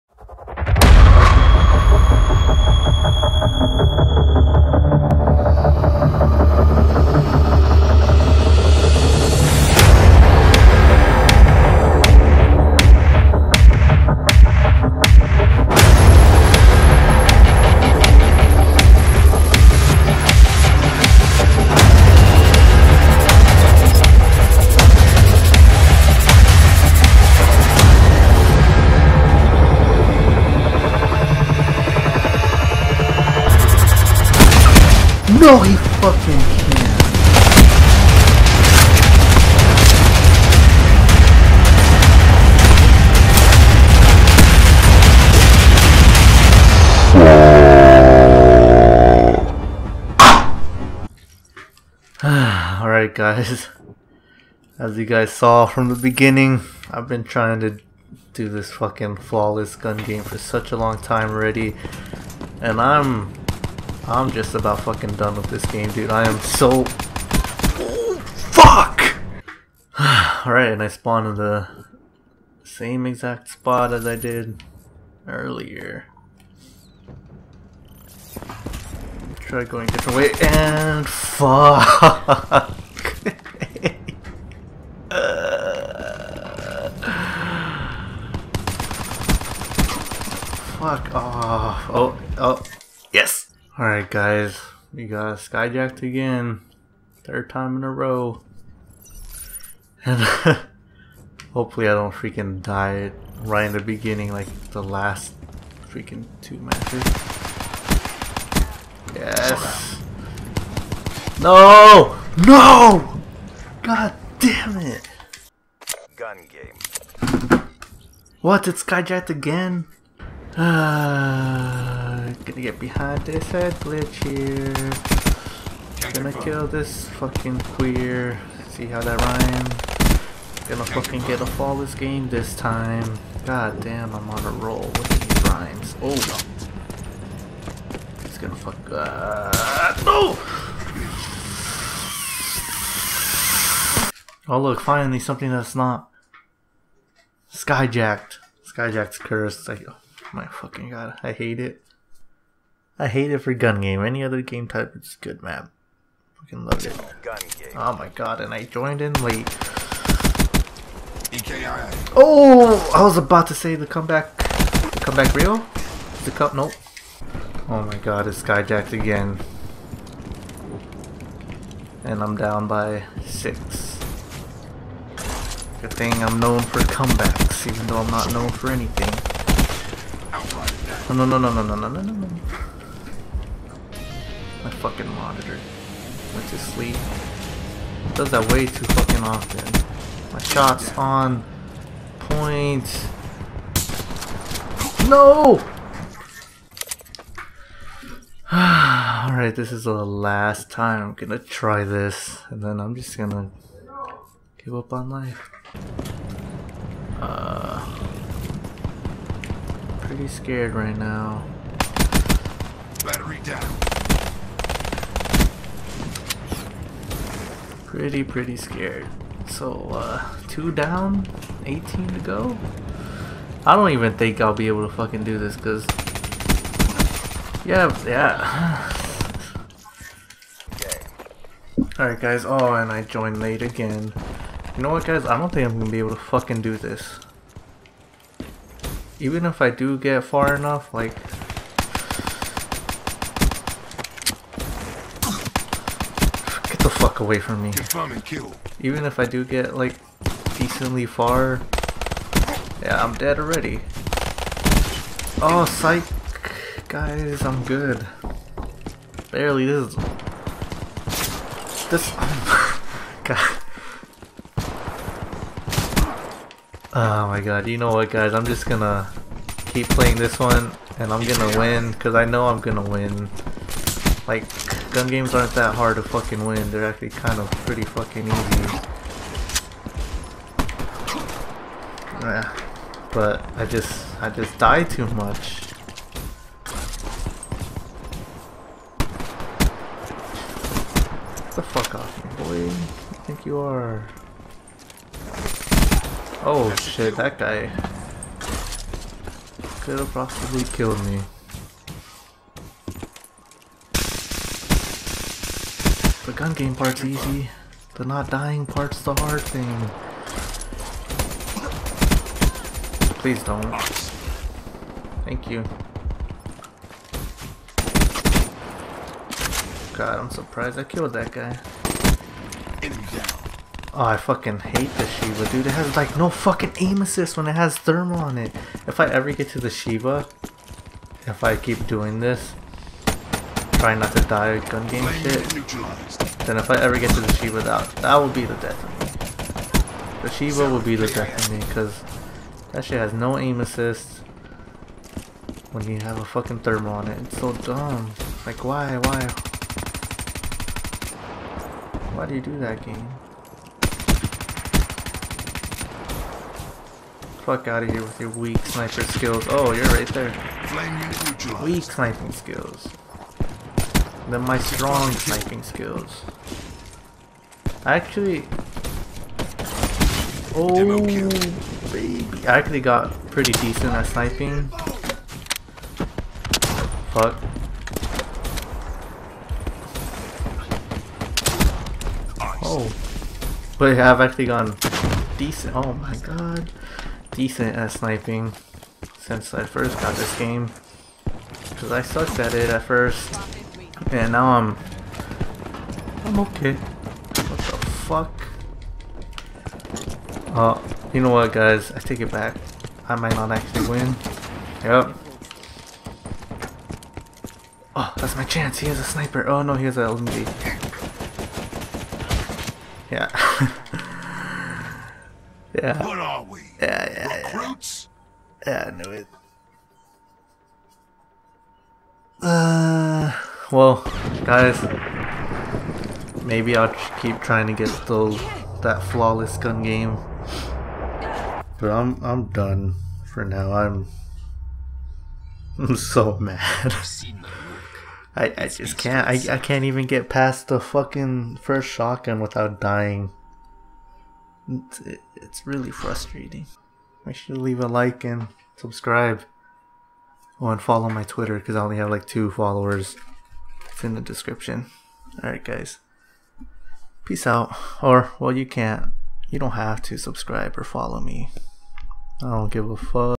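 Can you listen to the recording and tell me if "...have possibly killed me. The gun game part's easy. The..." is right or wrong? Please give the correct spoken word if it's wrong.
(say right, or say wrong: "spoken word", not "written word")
right.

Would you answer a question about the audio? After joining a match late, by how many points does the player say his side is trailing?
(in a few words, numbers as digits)
6.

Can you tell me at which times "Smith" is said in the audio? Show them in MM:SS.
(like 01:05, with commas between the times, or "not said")
not said.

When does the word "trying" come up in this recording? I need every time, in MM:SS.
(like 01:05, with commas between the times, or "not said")
00:57, 05:33, 07:07.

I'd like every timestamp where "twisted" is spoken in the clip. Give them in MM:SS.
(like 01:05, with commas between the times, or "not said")
not said.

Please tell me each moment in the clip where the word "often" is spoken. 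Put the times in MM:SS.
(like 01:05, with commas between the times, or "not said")
03:09.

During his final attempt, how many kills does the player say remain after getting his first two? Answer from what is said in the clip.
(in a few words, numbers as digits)
18.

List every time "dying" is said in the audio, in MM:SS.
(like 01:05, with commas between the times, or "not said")
05:08, 07:22.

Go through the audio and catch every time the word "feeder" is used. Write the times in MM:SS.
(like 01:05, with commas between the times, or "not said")
not said.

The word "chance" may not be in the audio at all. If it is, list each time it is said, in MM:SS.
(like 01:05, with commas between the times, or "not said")
06:48.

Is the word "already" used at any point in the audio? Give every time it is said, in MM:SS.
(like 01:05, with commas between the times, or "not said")
01:01, 04:13.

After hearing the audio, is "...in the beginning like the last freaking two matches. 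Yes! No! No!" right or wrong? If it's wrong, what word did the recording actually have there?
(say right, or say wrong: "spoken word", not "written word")
right.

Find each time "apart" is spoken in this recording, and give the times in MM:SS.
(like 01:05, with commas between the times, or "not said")
not said.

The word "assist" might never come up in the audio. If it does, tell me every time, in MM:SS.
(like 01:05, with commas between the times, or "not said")
05:27, 05:43.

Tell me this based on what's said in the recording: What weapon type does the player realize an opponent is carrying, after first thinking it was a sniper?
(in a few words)
LMG.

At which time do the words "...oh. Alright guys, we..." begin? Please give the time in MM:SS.
01:32.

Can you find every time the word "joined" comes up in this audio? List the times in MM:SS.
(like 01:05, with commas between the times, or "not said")
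02:38, 03:53.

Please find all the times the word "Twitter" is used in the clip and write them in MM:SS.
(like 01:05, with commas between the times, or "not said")
07:31.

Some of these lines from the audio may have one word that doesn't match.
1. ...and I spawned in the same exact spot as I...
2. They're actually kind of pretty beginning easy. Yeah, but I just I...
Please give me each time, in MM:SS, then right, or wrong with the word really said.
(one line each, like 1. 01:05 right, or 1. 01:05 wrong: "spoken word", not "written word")
1. 01:10 right
2. 04:36 wrong: "fucking", not "beginning".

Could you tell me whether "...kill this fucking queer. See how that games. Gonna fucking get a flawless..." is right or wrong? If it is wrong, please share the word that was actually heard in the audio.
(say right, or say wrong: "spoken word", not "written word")
wrong: "rhymes", not "games".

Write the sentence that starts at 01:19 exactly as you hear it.
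Try going a different way, and fuck!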